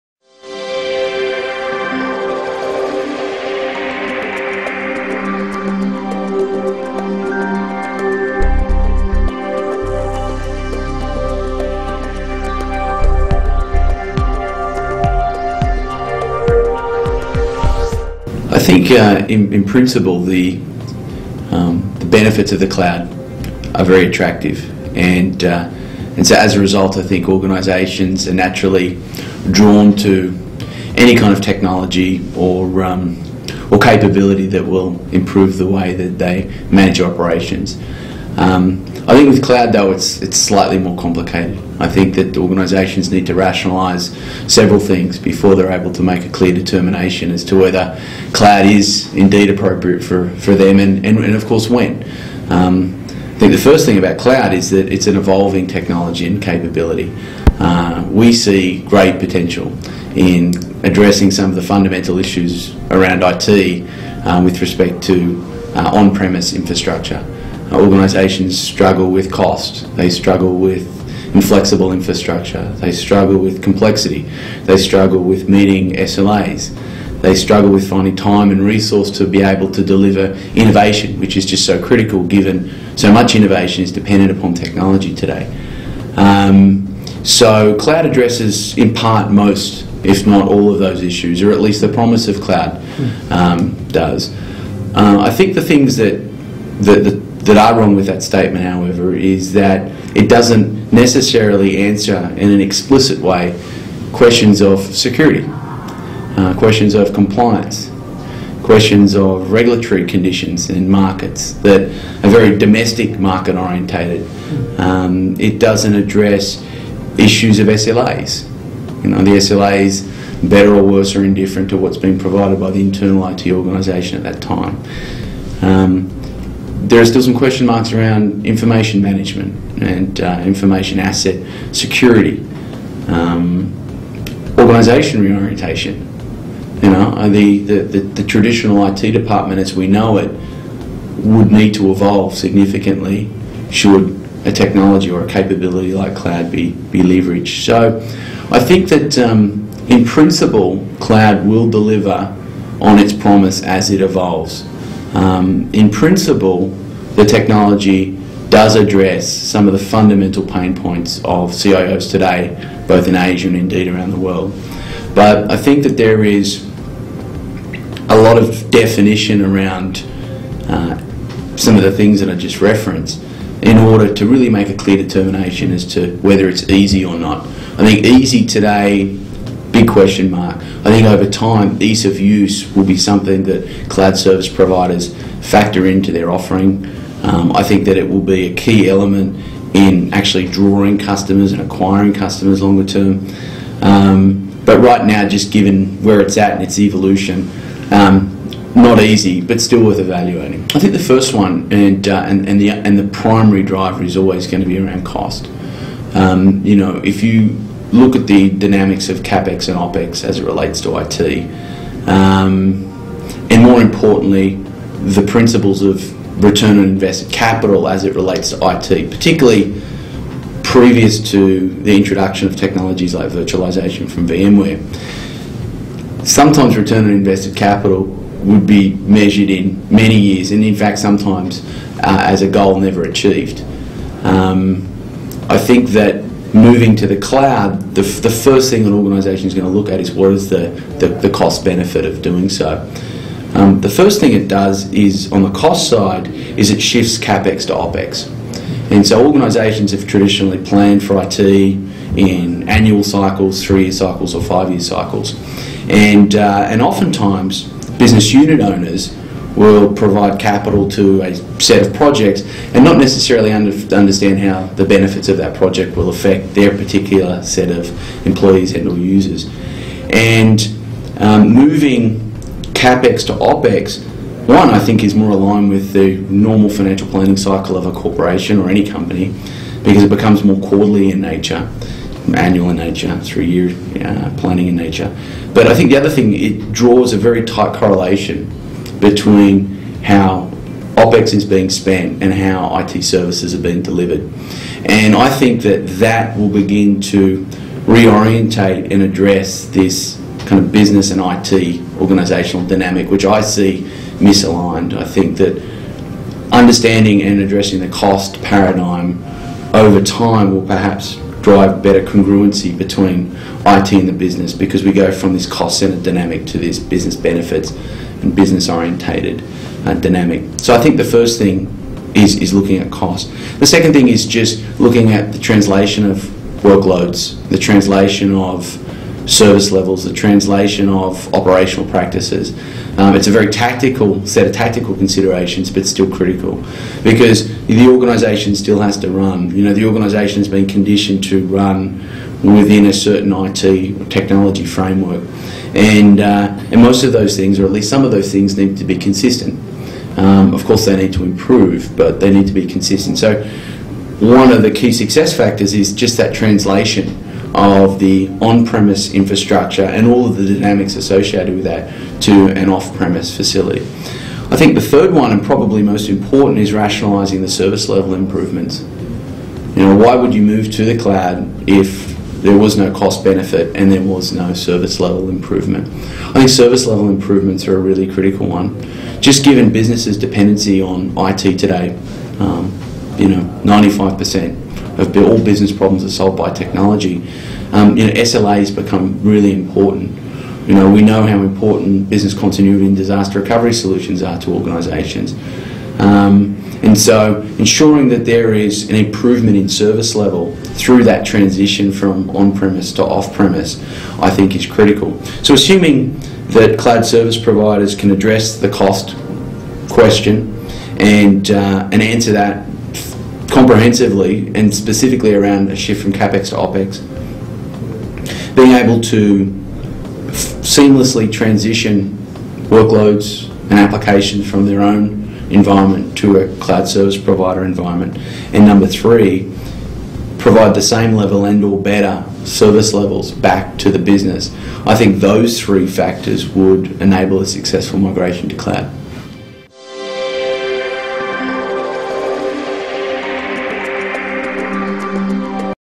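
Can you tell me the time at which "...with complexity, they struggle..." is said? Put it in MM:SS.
01:13.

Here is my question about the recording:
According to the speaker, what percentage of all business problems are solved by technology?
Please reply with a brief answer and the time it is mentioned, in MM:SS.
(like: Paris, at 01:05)
95%, at 06:23.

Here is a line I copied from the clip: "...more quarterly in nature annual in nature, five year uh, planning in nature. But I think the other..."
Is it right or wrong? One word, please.
wrong.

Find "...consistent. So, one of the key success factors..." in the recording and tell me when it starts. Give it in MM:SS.
05:52.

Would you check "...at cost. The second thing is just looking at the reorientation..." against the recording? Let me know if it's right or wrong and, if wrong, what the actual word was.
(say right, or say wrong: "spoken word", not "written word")
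wrong: "translation", not "reorientation".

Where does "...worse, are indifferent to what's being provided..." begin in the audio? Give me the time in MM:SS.
02:00.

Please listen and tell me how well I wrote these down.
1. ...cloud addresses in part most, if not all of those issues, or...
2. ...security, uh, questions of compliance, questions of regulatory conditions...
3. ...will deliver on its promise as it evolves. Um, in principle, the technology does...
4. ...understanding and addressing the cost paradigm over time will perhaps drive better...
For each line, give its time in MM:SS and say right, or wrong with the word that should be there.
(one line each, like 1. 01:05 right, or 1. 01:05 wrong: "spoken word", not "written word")
1. 01:27 right
2. 01:44 right
3. 02:31 right
4. 05:06 right.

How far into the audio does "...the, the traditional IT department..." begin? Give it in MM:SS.
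02:17.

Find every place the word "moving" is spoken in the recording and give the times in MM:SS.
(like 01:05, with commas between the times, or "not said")
03:56, 04:31.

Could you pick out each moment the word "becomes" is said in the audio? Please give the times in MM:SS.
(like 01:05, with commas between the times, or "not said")
04:40, 06:28.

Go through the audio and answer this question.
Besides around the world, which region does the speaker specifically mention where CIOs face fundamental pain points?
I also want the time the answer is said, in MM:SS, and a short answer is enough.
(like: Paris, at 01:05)
Asia, at 02:43.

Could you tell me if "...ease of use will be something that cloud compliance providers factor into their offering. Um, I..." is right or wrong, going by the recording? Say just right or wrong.
wrong.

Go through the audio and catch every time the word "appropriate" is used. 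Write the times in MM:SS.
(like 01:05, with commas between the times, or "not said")
00:49.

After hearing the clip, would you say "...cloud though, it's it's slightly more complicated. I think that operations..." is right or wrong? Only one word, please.
wrong.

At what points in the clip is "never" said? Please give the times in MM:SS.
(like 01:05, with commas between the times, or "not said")
03:52.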